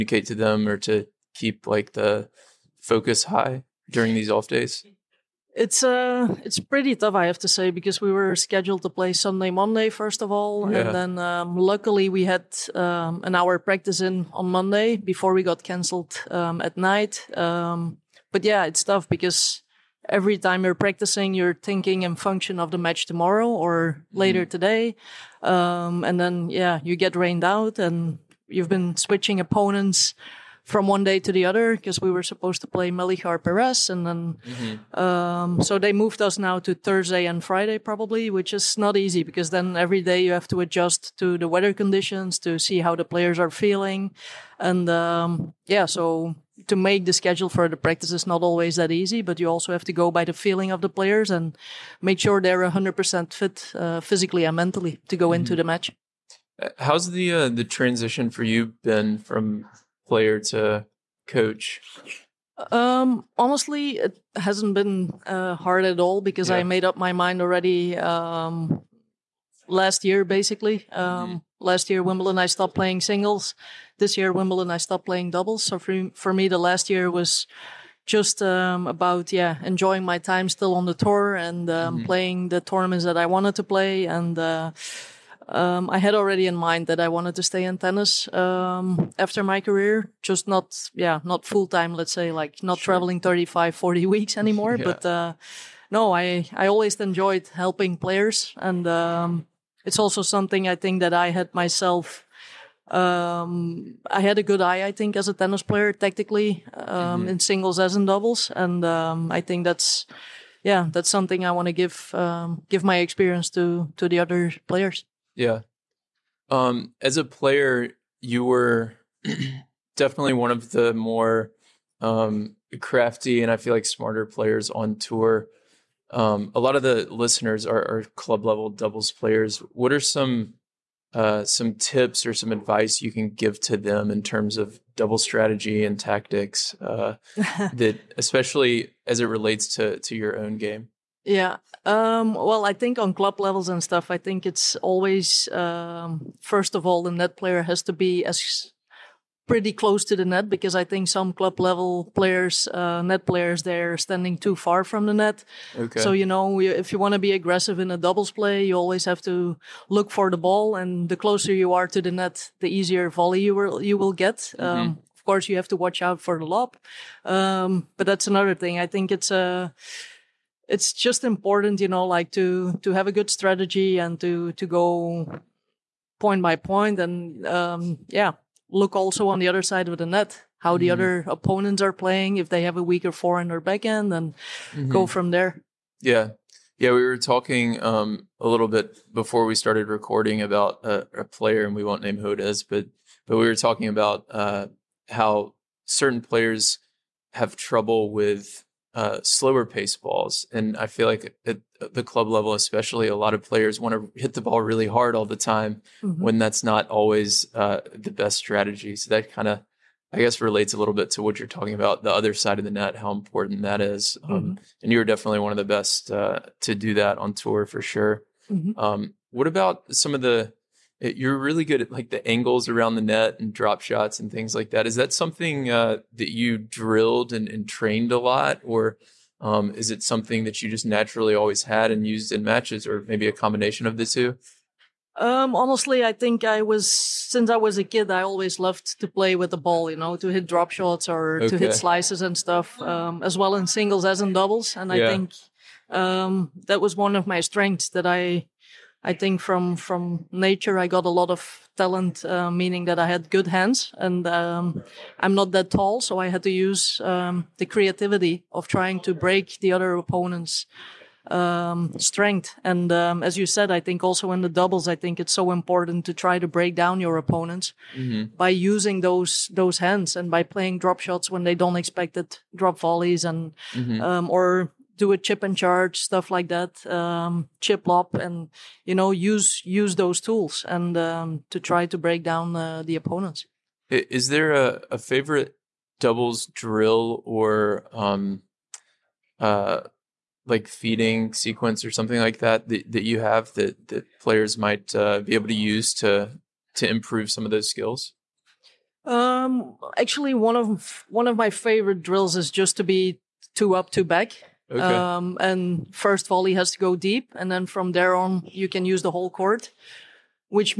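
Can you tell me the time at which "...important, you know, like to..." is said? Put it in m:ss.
2:51.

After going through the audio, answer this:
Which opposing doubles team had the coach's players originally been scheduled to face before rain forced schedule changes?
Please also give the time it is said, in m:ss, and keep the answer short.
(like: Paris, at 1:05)
Melichar Perez, at 0:32.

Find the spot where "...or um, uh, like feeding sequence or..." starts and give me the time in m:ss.
4:47.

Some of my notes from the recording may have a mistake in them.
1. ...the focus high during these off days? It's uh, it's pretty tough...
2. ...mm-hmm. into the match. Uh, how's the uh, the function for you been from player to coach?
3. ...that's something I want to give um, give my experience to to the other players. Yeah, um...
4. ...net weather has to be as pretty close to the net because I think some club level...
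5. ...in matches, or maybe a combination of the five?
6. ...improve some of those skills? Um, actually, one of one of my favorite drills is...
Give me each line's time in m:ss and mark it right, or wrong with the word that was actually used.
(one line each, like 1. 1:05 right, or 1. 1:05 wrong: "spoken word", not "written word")
1. 0:01 right
2. 0:55 wrong: "transition", not "function"
3. 1:50 right
4. 2:27 wrong: "player", not "weather"
5. 3:52 wrong: "two", not "five"
6. 4:56 right.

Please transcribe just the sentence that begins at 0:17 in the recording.
Um, but yeah, it's tough because every time you're practicing, you're thinking and function of the match tomorrow or later mm.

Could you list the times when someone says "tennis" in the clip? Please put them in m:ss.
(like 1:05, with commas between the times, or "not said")
1:27, 1:45.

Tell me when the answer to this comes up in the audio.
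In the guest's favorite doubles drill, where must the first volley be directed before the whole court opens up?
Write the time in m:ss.
5:06.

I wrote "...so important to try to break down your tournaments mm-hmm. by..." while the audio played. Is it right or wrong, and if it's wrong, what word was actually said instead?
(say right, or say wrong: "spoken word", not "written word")
wrong: "opponents", not "tournaments".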